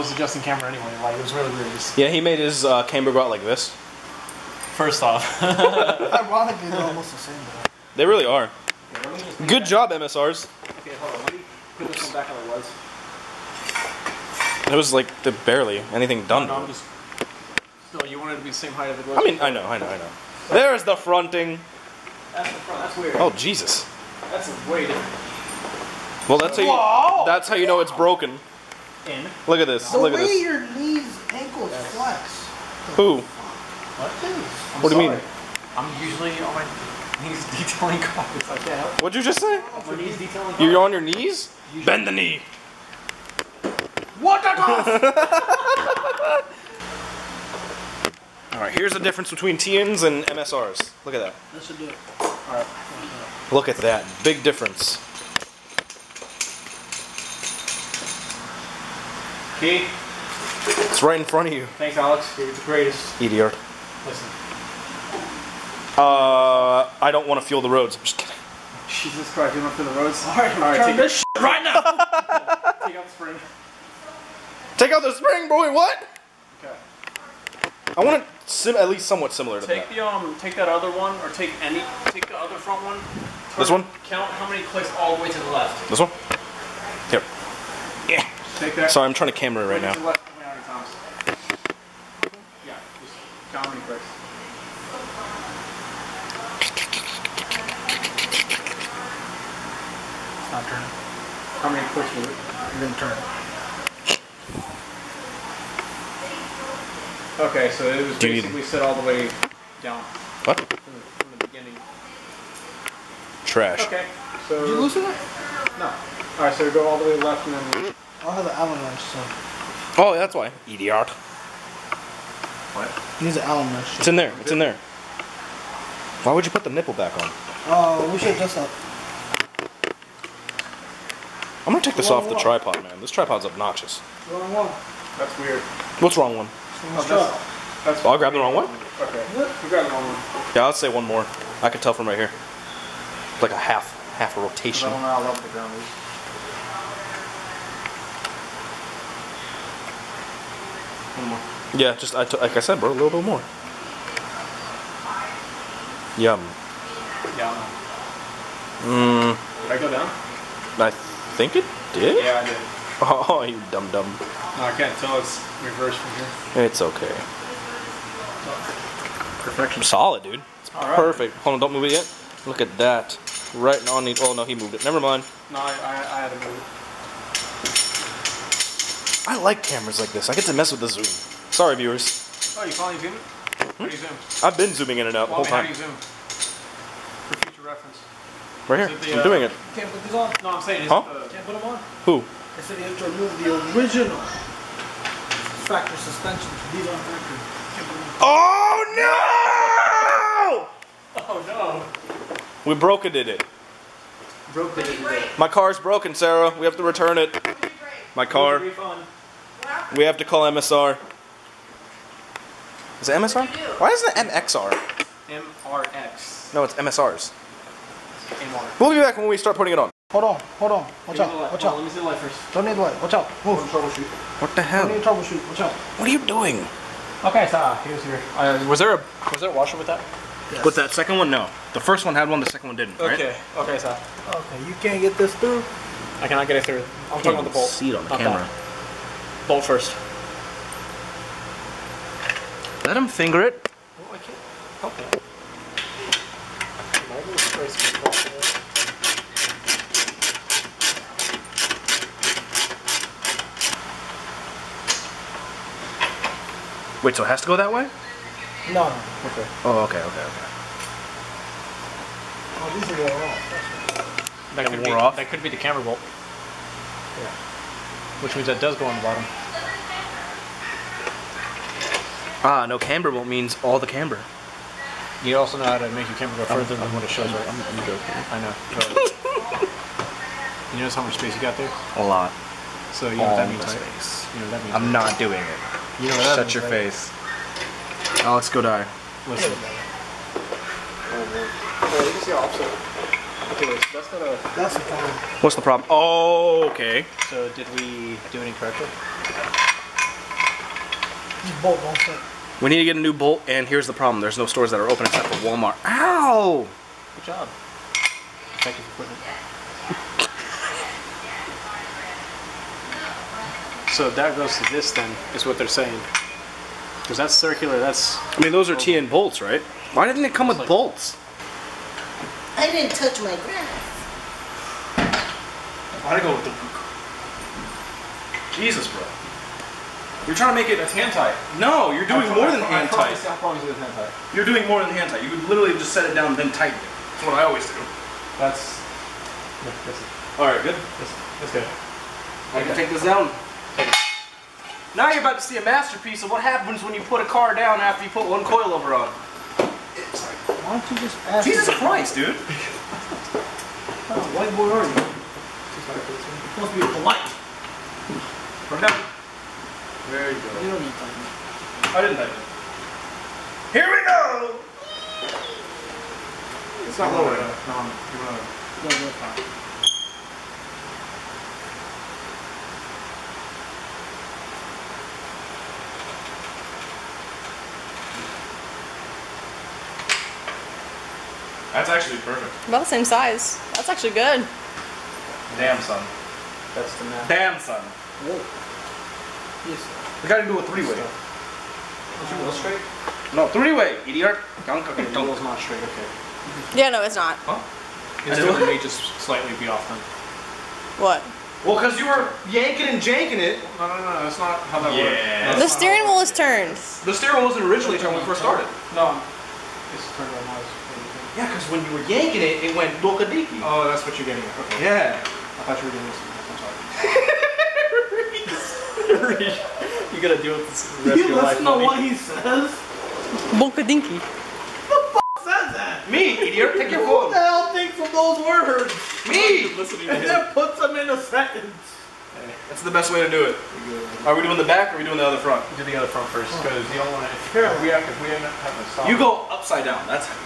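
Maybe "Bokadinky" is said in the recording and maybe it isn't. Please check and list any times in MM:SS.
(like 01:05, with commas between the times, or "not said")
07:03.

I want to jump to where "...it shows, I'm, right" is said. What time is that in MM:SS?
04:37.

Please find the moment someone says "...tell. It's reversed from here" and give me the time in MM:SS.
02:44.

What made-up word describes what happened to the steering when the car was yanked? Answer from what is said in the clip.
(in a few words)
dokadiki.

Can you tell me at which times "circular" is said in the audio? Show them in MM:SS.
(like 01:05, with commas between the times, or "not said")
05:17.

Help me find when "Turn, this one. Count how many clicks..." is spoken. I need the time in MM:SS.
01:23.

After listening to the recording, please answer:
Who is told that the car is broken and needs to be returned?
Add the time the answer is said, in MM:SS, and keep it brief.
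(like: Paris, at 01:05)
Sarah, at 03:26.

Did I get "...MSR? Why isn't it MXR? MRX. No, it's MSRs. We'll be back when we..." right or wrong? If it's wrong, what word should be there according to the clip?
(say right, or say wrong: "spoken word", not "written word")
right.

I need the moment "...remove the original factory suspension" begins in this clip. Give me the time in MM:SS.
03:13.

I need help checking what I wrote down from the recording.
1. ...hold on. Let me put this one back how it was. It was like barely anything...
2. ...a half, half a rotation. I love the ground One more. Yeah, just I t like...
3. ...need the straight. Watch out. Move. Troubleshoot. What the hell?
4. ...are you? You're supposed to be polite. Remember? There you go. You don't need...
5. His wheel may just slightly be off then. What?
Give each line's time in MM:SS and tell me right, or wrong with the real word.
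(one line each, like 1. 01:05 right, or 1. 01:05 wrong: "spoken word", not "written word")
1. 00:10 right
2. 02:23 right
3. 03:42 wrong: "light", not "straight"
4. 05:54 right
5. 06:38 right.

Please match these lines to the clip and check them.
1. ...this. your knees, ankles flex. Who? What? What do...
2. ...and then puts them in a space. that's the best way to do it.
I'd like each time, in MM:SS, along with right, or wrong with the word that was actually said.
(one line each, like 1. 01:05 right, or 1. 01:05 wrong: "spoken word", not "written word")
1. 00:30 right
2. 07:10 wrong: "sentence", not "space".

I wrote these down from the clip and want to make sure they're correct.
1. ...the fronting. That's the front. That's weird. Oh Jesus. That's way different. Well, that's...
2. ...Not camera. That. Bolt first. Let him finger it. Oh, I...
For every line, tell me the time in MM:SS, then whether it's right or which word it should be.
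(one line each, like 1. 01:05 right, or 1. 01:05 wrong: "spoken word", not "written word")
1. 00:20 right
2. 03:58 right.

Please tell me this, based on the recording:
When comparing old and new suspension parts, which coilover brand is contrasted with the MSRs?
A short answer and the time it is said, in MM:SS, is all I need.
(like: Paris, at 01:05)
TNs, at 00:49.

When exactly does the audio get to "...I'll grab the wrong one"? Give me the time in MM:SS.
02:18.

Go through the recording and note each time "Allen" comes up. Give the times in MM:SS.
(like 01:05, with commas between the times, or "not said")
01:58, 02:03.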